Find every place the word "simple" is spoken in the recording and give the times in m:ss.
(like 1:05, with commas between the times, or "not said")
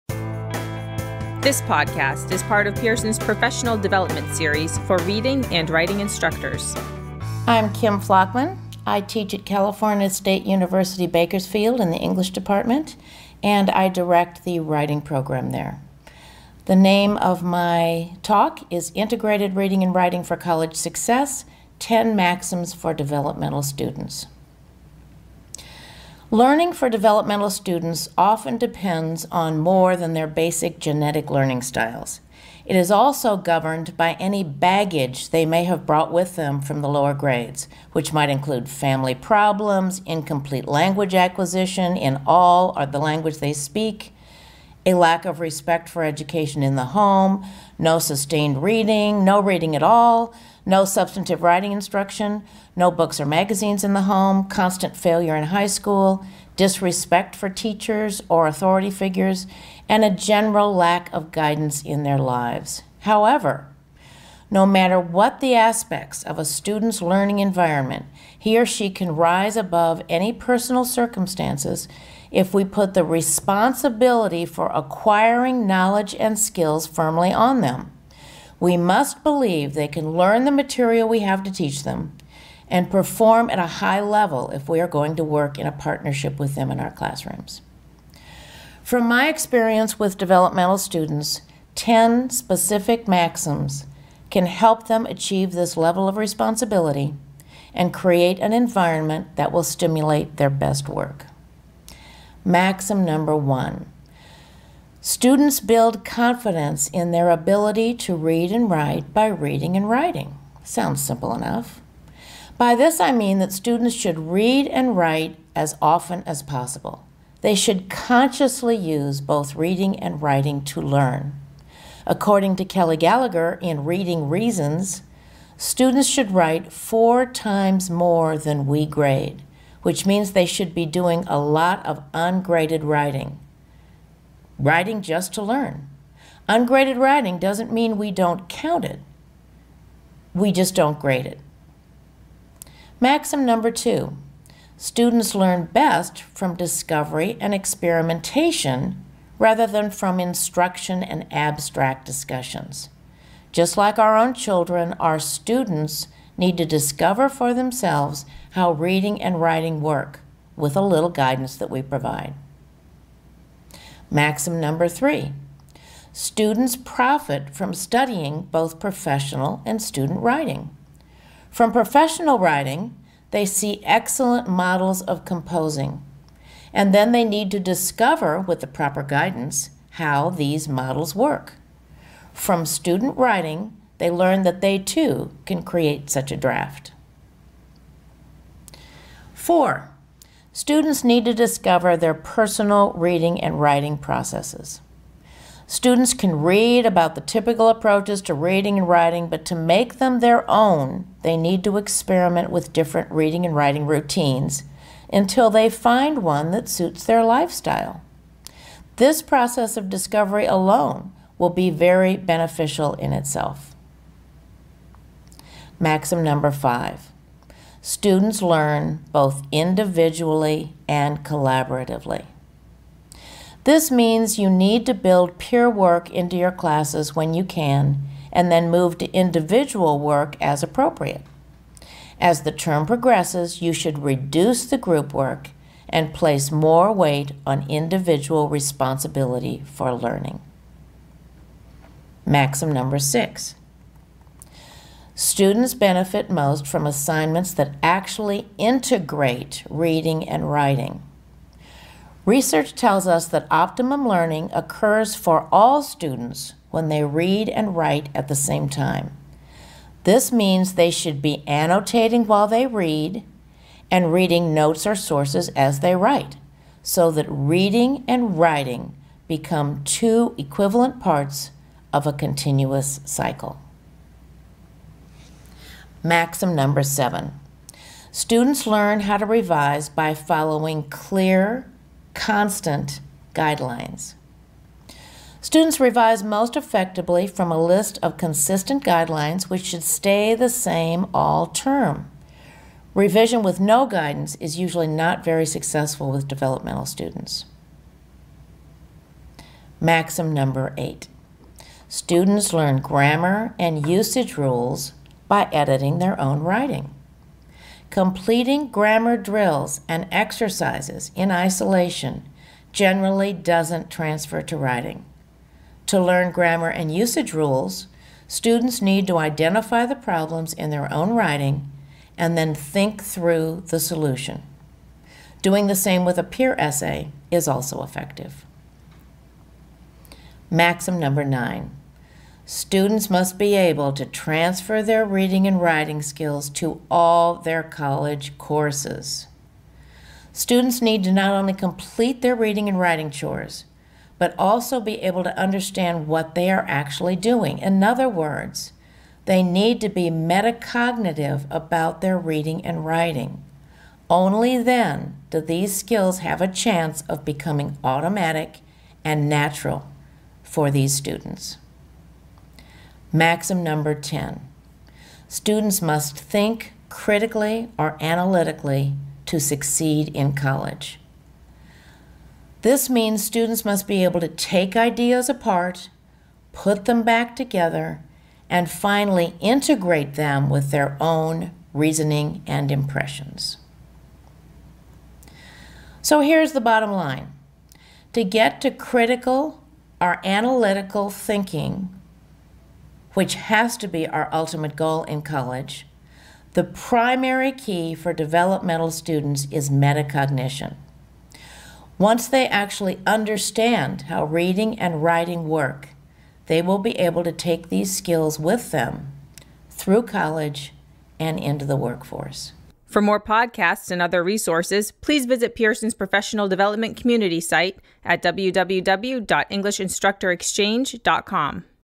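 1:51.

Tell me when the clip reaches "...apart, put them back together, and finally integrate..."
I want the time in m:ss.
6:15.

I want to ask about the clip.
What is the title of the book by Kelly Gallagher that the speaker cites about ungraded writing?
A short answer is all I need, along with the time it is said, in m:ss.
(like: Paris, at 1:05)
Reading Reasons, at 2:03.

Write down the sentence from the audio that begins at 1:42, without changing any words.
Maxim number one Students build confidence in their ability to read and write by reading and writing.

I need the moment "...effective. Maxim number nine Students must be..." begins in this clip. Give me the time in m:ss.
5:27.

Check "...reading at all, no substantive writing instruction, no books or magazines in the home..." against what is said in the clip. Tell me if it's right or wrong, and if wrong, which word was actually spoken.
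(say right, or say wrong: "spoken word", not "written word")
right.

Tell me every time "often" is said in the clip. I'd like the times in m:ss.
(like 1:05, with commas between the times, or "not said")
0:28, 1:55.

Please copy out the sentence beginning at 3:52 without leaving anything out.
As the term progresses, you should reduce the group work and place more weight on individual responsibility for learning.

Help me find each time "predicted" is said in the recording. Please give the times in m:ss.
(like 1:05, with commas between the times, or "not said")
not said.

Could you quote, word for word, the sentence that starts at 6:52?
For more podcasts and other resources, please visit Pearson's professional development community site at www.englishinstructorexchange.com.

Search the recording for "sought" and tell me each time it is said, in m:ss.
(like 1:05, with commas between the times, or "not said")
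not said.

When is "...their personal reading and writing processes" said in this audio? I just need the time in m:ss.
3:11.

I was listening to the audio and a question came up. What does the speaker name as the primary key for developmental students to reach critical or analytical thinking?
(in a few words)
metacognition.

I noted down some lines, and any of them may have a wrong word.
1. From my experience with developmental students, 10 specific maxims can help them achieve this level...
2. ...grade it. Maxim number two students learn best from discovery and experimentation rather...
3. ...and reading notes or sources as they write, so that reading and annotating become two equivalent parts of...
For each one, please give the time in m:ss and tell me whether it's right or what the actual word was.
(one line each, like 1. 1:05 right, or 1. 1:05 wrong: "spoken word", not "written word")
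1. 1:28 right
2. 2:20 right
3. 4:23 wrong: "writing", not "annotating".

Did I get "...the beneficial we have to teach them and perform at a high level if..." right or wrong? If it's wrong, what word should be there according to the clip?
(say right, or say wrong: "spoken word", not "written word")
wrong: "material", not "beneficial".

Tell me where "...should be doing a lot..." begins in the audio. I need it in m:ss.
2:10.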